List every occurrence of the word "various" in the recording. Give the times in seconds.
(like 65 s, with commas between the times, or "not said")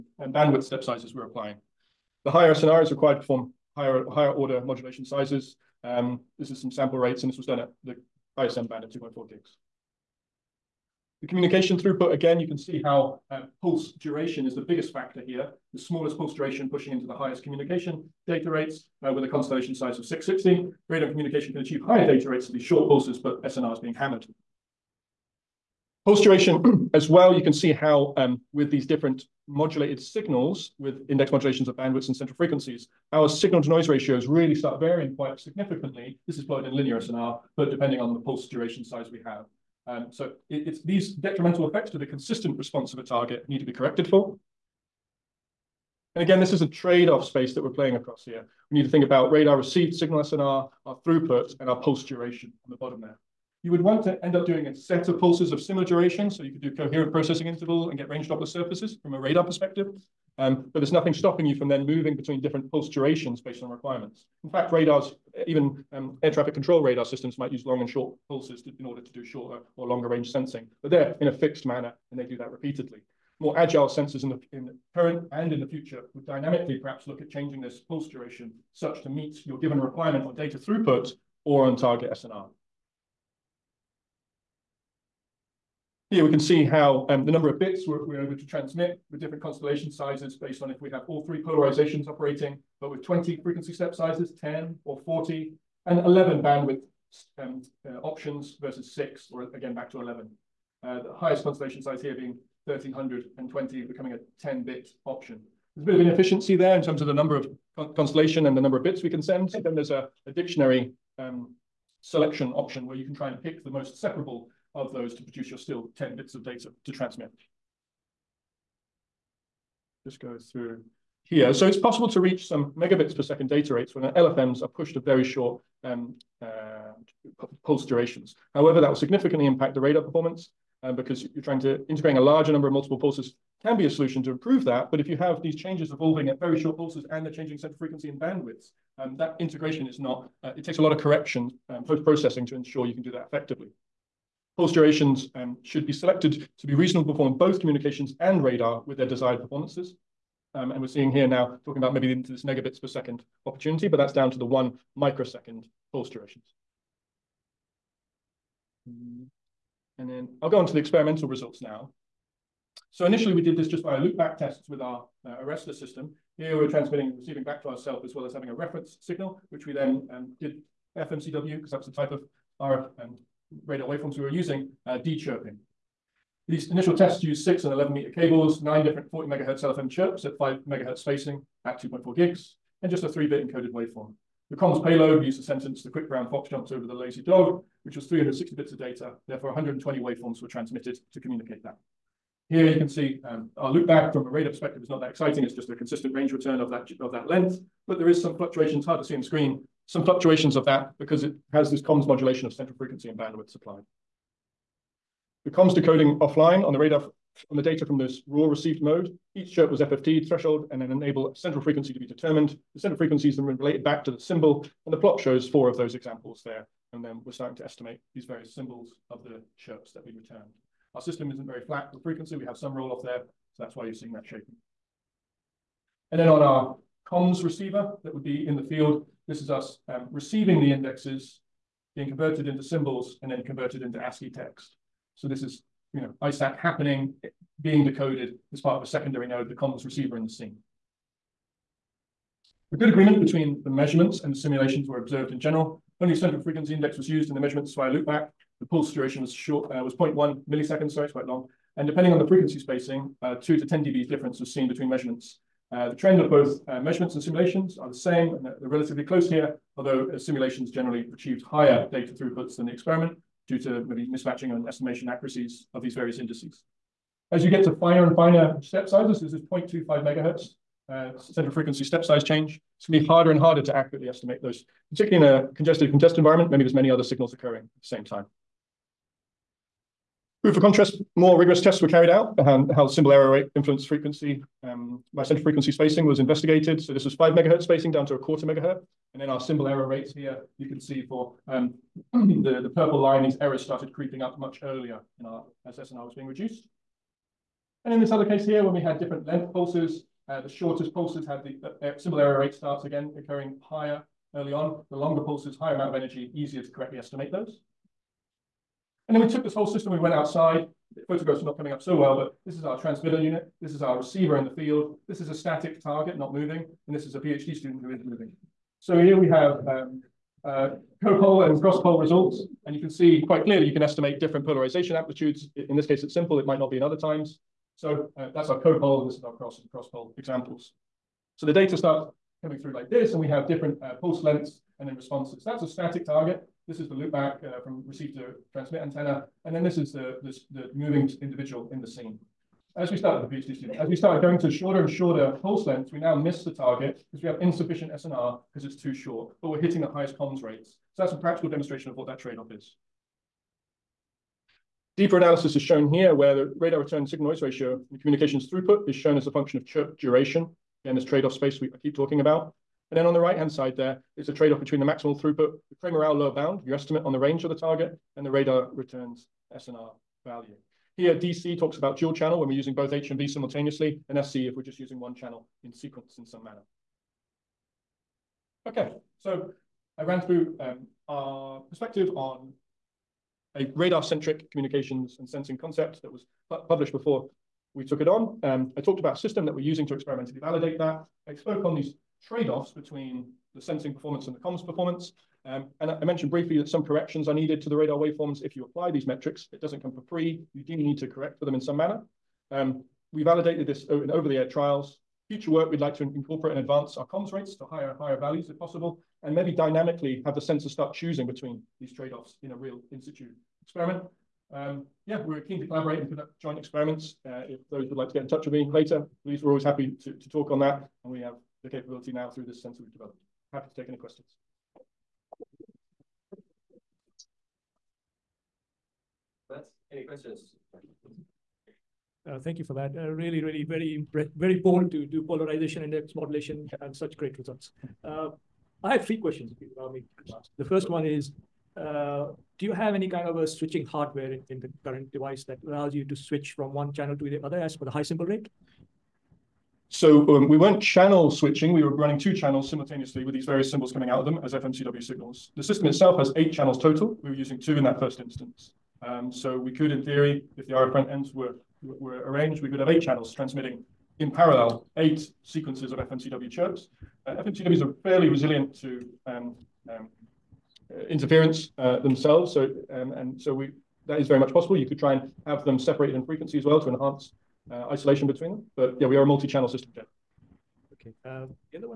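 218 s, 265 s, 453 s.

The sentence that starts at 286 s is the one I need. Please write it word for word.
So this was five megahertz spacing down to a quarter megahertz.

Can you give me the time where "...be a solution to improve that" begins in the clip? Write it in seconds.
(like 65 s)
133 s.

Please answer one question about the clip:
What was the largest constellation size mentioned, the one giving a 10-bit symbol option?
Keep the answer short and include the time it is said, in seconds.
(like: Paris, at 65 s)
1320, at 102 s.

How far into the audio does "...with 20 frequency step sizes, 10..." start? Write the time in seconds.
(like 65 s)
92 s.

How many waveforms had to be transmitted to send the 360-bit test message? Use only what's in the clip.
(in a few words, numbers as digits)
120.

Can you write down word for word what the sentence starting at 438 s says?
Uh, I have three questions, if you allow me.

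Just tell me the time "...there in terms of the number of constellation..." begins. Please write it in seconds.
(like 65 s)
106 s.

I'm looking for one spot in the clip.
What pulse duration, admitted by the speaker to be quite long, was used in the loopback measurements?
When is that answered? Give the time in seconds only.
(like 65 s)
249 s.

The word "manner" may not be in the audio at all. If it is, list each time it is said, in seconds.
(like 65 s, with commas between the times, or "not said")
71 s, 376 s, 401 s.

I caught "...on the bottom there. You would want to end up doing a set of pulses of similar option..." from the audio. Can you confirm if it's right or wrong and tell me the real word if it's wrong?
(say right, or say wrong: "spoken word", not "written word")
wrong: "duration", not "option".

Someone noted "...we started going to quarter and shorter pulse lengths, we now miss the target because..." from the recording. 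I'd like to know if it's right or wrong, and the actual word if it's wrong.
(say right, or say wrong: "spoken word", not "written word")
wrong: "shorter", not "quarter".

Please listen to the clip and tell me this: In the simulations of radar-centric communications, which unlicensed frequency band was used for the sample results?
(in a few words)
ISM band at 2.4 GHz.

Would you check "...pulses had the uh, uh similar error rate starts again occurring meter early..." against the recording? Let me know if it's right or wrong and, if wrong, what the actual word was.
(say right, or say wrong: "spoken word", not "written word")
wrong: "higher", not "meter".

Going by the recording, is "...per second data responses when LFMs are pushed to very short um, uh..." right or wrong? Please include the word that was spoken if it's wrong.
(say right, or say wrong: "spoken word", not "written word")
wrong: "rates", not "responses".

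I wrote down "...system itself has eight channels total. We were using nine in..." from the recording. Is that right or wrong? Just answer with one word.
wrong.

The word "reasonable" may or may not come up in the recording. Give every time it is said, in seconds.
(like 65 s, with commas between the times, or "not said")
146 s.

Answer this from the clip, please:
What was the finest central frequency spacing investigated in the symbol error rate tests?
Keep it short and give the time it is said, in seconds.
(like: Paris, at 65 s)
0.25 MHz, at 269 s.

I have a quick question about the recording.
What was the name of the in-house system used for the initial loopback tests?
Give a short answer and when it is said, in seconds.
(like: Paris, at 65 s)
ARESTOR, at 165 s.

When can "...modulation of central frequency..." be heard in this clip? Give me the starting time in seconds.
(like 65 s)
202 s.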